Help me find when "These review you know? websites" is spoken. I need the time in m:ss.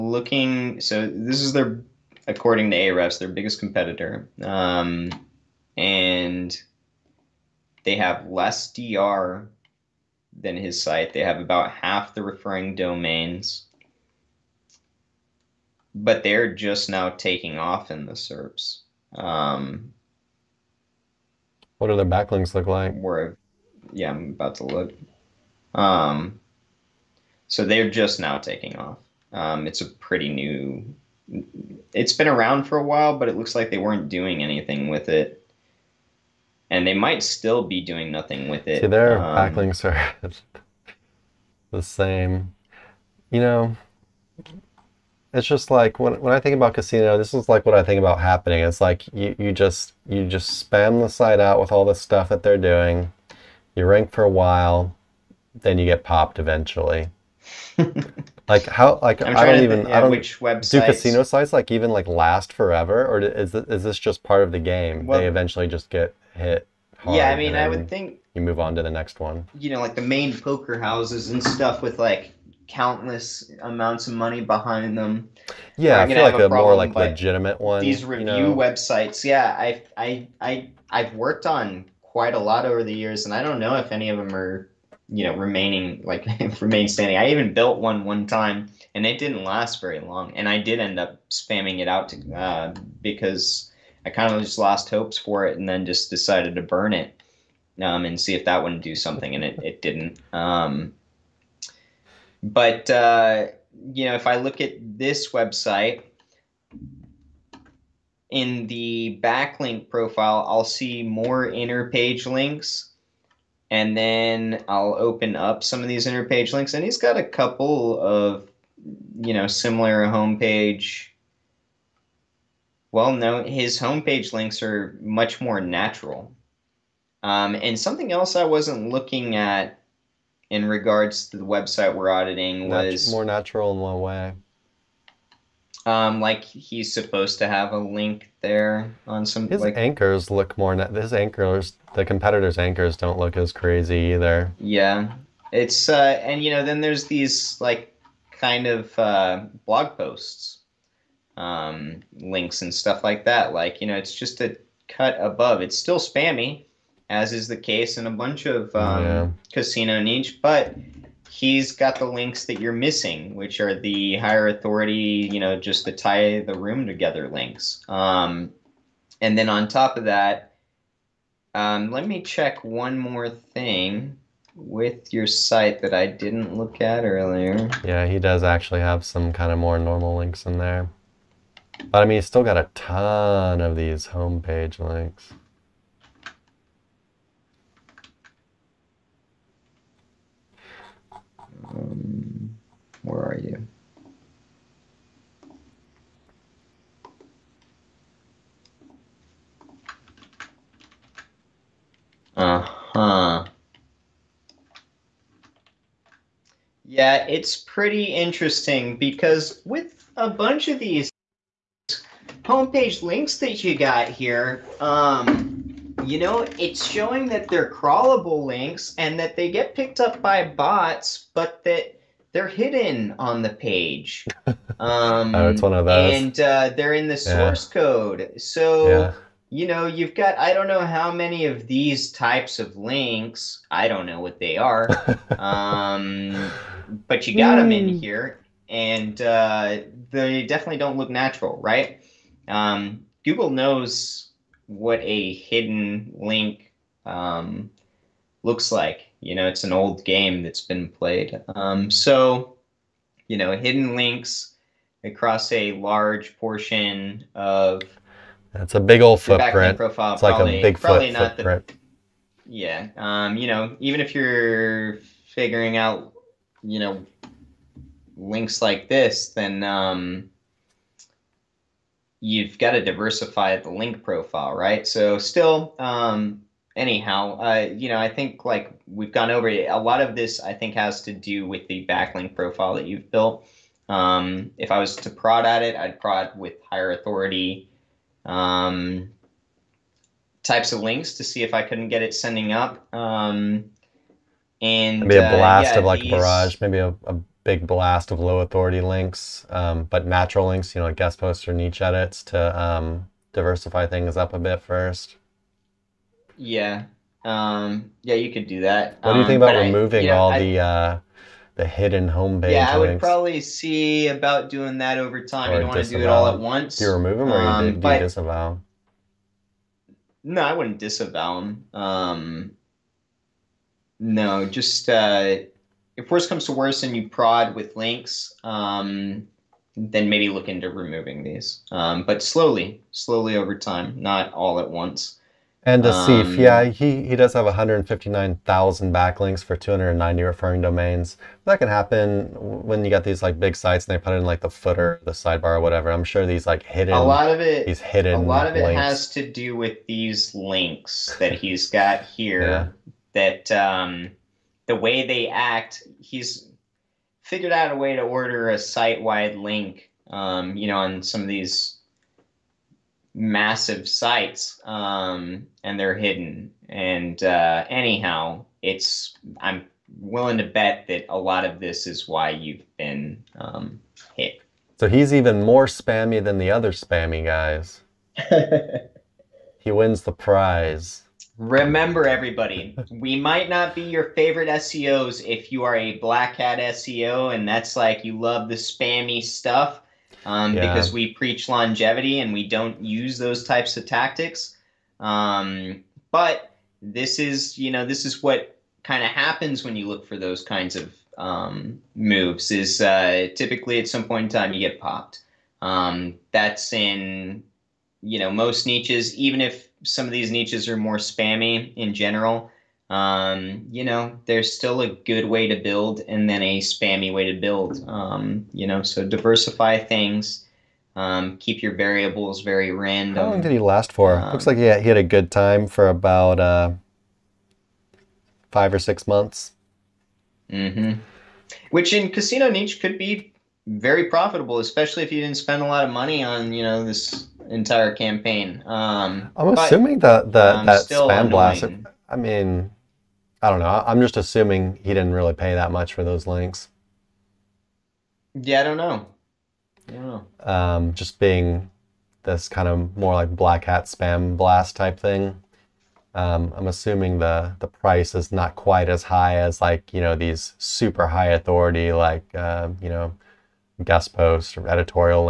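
1:17.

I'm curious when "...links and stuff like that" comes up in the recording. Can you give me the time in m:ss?
2:32.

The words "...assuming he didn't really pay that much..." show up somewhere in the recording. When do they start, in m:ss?
7:24.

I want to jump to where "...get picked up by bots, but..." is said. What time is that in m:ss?
3:39.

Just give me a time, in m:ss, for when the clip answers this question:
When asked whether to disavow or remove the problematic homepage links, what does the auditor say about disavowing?
5:20.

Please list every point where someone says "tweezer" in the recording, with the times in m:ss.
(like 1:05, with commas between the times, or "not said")
not said.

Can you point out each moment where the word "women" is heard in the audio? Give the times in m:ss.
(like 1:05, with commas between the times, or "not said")
not said.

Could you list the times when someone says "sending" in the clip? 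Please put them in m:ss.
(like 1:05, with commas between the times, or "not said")
4:52.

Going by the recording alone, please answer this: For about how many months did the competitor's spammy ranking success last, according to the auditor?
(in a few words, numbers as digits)
5 or 6 months.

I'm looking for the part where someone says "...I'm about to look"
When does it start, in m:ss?
0:24.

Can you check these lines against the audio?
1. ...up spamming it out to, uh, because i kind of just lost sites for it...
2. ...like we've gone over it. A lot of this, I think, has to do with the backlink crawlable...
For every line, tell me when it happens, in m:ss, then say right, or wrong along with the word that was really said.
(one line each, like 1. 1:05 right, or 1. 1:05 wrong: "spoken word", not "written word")
1. 1:30 wrong: "hopes", not "sites"
2. 4:38 wrong: "profile", not "crawlable".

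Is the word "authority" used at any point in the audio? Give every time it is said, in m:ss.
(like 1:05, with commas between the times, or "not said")
2:44, 4:46, 4:58, 7:41.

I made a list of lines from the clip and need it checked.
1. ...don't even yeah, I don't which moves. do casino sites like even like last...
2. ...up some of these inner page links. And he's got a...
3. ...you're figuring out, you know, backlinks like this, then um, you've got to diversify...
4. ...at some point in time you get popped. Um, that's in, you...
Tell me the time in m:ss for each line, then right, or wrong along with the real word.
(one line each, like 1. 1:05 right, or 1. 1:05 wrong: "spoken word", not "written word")
1. 0:59 wrong: "websites", not "moves"
2. 1:55 right
3. 4:24 wrong: "links", not "backlinks"
4. 6:43 right.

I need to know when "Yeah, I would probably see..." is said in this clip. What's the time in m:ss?
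5:12.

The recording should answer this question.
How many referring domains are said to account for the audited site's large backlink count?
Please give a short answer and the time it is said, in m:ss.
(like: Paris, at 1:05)
290, at 5:39.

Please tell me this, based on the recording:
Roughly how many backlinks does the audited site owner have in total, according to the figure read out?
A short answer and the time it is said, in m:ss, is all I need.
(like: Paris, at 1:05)
159,000, at 5:37.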